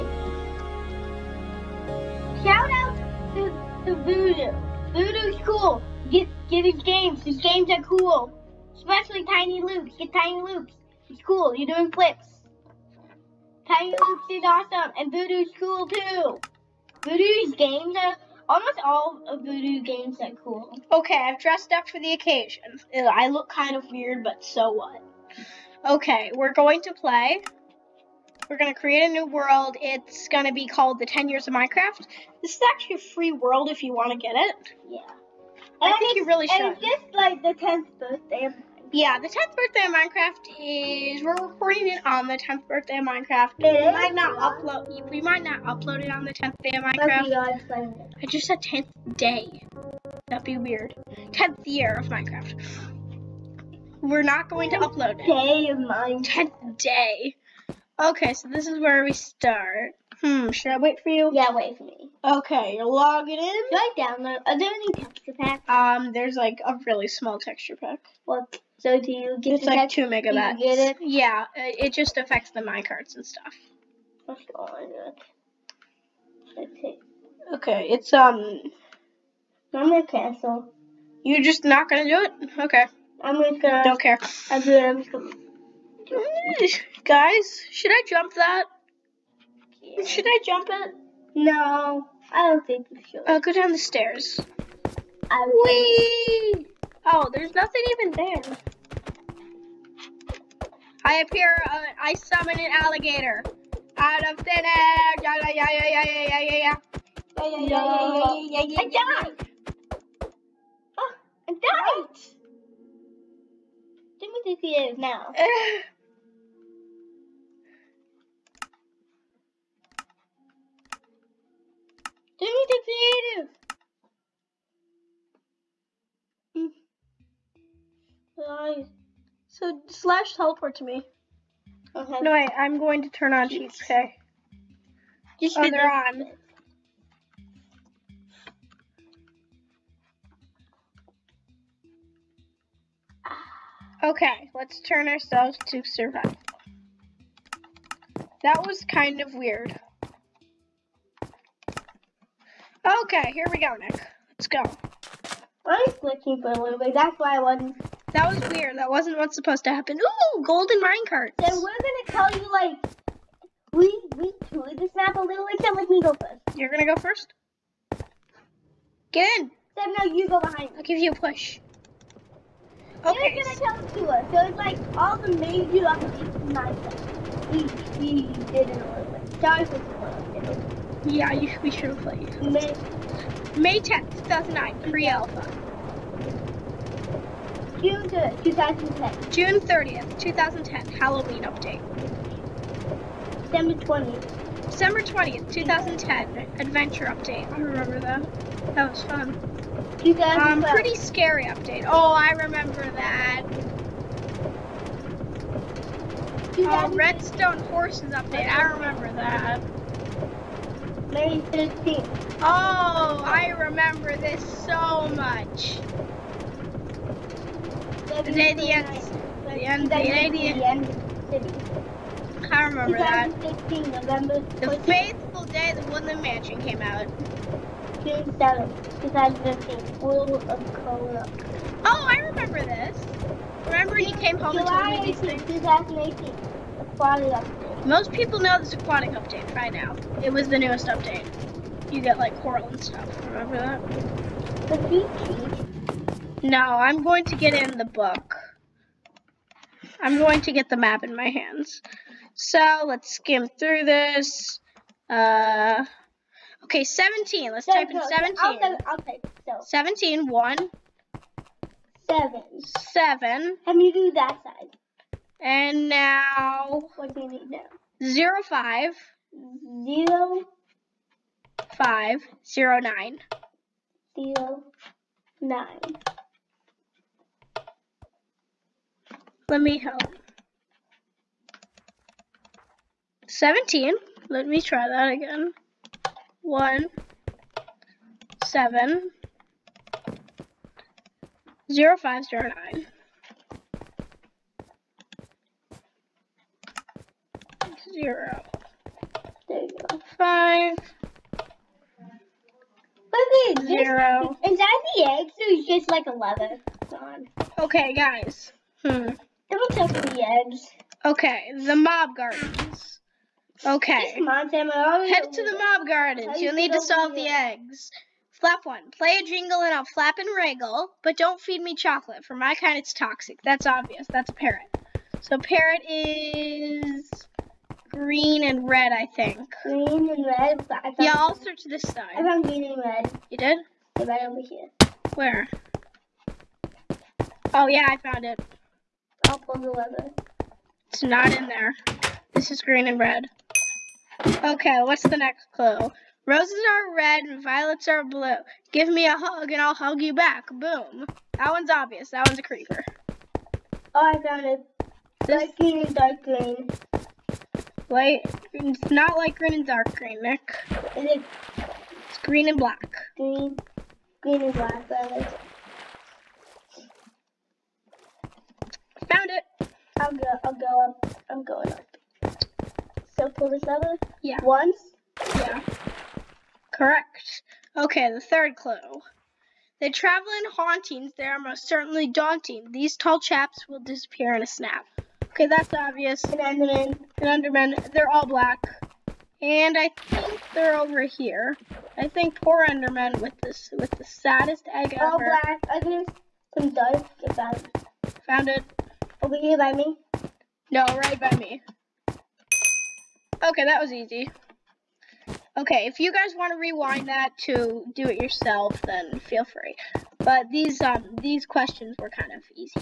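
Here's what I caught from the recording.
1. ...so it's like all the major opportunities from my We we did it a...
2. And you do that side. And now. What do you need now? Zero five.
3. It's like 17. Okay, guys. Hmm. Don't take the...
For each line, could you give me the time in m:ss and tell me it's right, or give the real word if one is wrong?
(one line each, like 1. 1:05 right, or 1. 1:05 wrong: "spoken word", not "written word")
1. 2:54 right
2. 4:23 right
3. 5:05 wrong: "11", not "17".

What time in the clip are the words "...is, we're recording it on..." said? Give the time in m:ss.
0:41.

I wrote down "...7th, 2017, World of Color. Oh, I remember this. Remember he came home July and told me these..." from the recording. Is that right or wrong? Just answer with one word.
wrong.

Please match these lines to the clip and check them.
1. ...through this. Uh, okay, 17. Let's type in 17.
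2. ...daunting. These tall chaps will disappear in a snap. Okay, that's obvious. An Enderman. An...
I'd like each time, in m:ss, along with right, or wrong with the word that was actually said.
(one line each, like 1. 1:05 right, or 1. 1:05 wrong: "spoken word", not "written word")
1. 4:13 right
2. 6:22 right.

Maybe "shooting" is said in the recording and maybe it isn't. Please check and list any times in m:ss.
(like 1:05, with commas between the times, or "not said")
not said.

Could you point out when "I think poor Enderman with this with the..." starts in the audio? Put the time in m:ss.
6:31.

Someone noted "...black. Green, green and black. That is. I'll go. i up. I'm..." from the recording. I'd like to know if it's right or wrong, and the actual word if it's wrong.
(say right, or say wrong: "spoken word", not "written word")
right.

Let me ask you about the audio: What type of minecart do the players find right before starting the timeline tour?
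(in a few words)
golden minecart.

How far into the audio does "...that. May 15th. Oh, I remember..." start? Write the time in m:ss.
3:29.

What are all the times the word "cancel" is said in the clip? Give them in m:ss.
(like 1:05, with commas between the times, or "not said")
1:20.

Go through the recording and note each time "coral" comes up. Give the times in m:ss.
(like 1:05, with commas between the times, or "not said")
4:02.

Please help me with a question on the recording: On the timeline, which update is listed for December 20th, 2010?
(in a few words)
adventure update.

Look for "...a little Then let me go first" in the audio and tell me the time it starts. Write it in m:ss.
2:45.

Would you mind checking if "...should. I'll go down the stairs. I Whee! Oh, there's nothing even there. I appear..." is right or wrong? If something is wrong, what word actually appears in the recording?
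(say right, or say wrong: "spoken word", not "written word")
right.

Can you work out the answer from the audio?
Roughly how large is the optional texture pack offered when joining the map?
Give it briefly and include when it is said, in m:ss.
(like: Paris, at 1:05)
2 megabytes, at 1:09.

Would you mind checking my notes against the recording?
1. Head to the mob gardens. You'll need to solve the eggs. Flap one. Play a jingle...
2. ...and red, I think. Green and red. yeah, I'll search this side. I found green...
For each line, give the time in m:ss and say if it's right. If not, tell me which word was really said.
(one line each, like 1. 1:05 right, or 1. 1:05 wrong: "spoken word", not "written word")
1. 5:13 right
2. 5:28 right.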